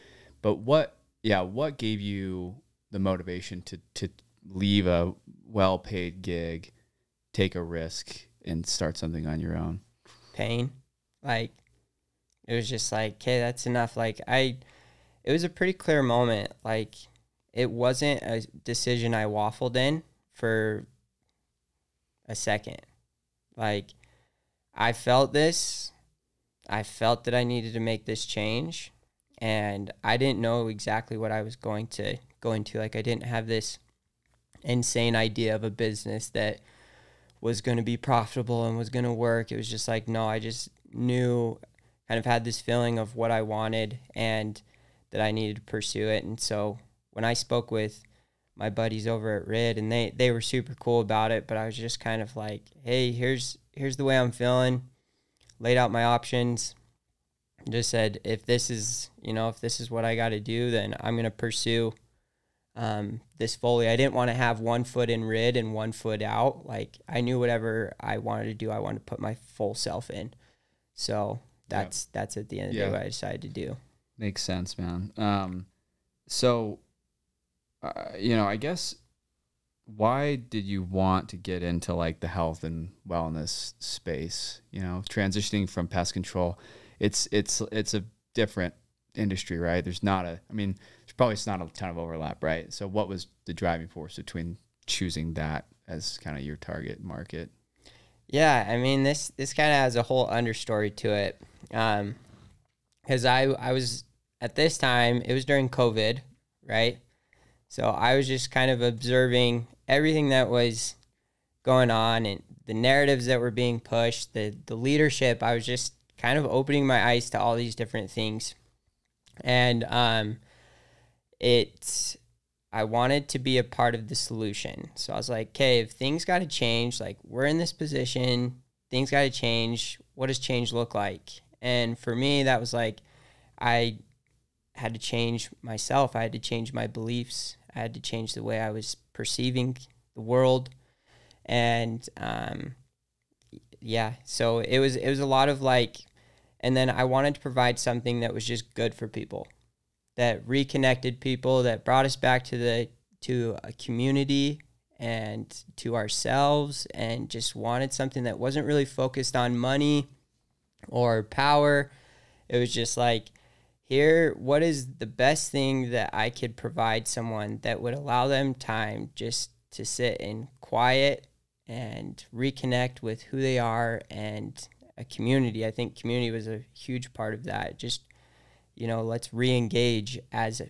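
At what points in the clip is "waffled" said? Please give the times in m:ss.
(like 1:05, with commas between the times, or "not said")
0:19.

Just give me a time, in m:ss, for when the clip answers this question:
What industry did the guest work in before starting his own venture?
1:25.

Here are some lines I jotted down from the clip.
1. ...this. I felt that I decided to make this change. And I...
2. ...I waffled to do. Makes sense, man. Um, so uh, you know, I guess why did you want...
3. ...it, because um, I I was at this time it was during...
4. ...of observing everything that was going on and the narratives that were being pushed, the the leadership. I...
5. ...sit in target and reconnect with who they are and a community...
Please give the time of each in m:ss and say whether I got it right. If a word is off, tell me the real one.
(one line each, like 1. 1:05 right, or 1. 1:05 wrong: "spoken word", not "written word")
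1. 0:25 wrong: "needed", not "decided"
2. 1:13 wrong: "decided", not "waffled"
3. 1:41 right
4. 1:48 right
5. 2:49 wrong: "quiet", not "target".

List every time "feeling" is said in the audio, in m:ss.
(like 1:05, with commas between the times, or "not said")
0:42, 0:54.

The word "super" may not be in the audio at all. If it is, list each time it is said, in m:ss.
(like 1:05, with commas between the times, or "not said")
0:50.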